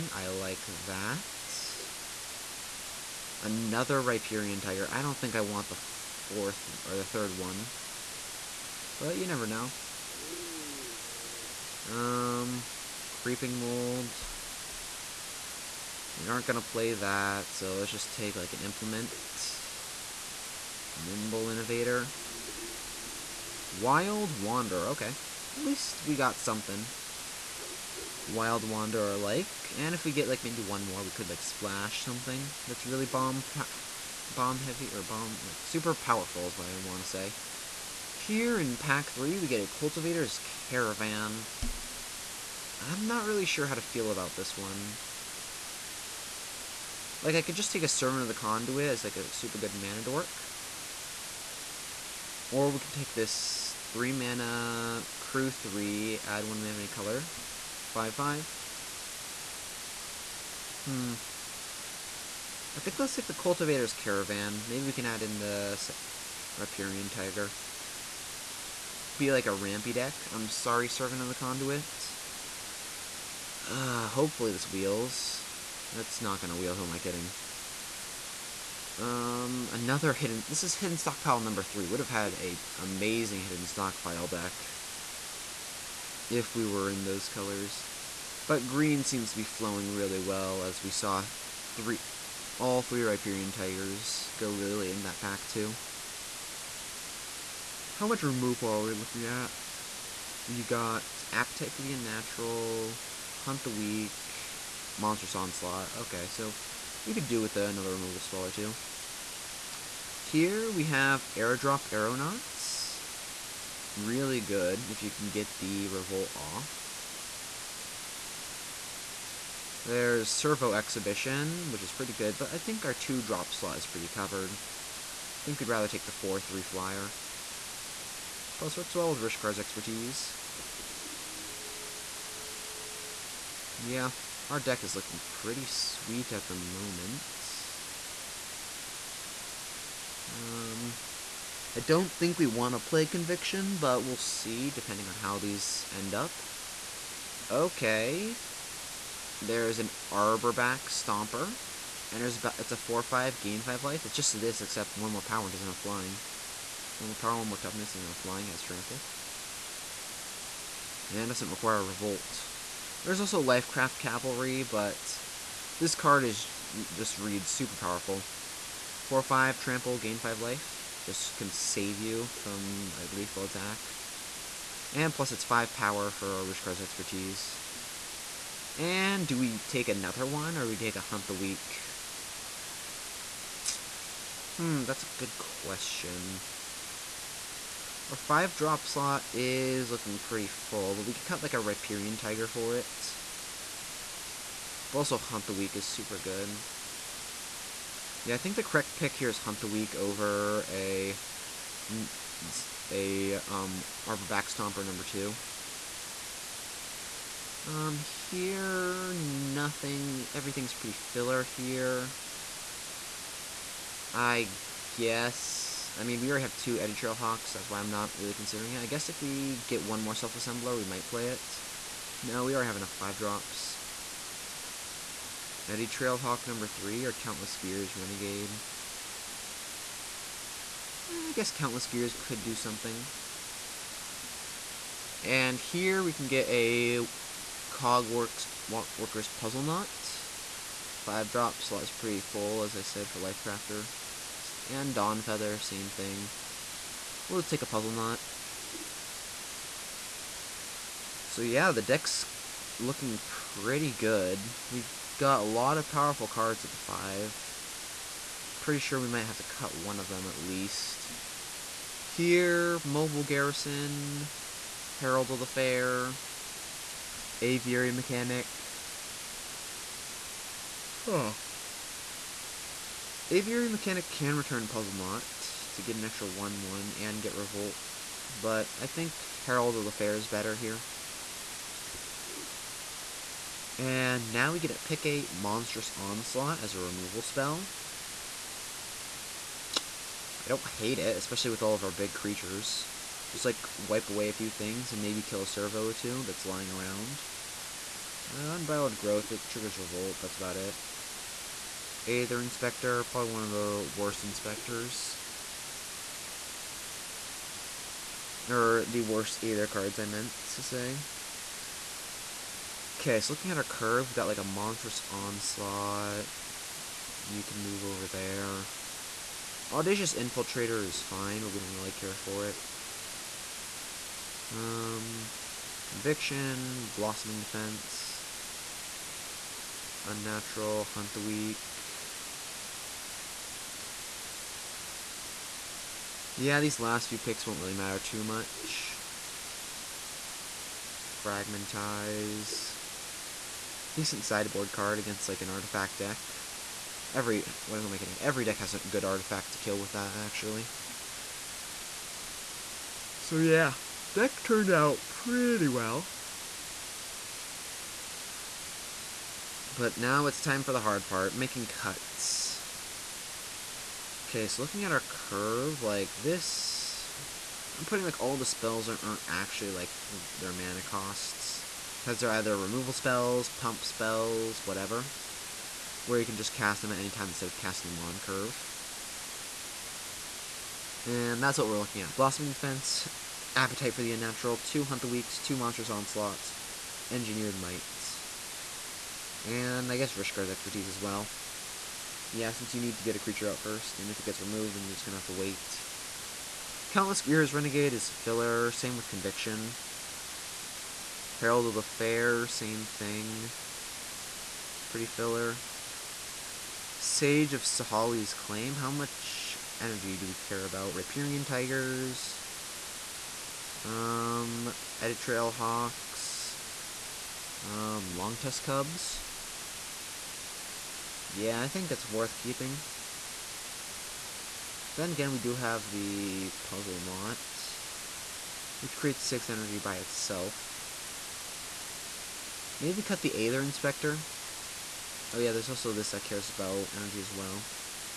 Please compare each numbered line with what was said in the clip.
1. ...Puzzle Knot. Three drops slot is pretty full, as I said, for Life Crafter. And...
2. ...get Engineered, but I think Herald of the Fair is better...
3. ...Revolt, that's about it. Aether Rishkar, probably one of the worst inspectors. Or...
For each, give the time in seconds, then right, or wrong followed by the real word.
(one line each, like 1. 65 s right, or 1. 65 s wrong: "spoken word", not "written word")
1. 239 s wrong: "Five", not "Three"
2. 277 s wrong: "Revolt", not "Engineered"
3. 299 s wrong: "Inspector", not "Rishkar".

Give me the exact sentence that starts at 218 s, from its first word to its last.
I guess if we get one more Self Assembler, we might play it.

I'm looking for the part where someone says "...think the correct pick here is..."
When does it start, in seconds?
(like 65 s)
198 s.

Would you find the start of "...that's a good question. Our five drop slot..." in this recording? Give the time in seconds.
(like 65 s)
184 s.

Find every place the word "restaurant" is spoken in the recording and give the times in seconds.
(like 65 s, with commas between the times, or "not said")
not said.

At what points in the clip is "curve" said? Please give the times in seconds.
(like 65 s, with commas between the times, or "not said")
313 s, 364 s, 378 s.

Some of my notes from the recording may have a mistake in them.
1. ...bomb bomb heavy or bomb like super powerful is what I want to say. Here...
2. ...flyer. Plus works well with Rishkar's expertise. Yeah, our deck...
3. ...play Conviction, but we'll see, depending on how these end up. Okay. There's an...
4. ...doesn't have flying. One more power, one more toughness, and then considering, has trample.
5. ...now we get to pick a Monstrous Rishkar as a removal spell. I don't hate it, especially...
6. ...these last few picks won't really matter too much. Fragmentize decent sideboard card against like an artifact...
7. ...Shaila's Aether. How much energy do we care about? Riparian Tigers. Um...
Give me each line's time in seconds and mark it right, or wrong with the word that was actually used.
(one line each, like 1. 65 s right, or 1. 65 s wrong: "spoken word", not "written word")
1. 33 s right
2. 126 s right
3. 142 s right
4. 155 s wrong: "flying", not "considering"
5. 284 s wrong: "Onslaught", not "Rishkar"
6. 336 s right
7. 407 s wrong: "Claim", not "Aether".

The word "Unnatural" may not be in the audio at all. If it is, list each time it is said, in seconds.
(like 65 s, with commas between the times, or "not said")
101 s, 330 s, 384 s.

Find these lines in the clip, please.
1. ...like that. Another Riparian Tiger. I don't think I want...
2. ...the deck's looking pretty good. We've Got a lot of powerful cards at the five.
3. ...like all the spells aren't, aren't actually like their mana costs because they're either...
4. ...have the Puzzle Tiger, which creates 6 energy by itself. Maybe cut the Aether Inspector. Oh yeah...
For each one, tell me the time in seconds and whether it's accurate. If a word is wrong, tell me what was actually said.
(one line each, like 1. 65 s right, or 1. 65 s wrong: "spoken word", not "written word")
1. 0 s right
2. 251 s right
3. 368 s right
4. 425 s wrong: "Knot", not "Tiger".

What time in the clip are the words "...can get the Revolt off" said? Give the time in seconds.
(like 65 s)
115 s.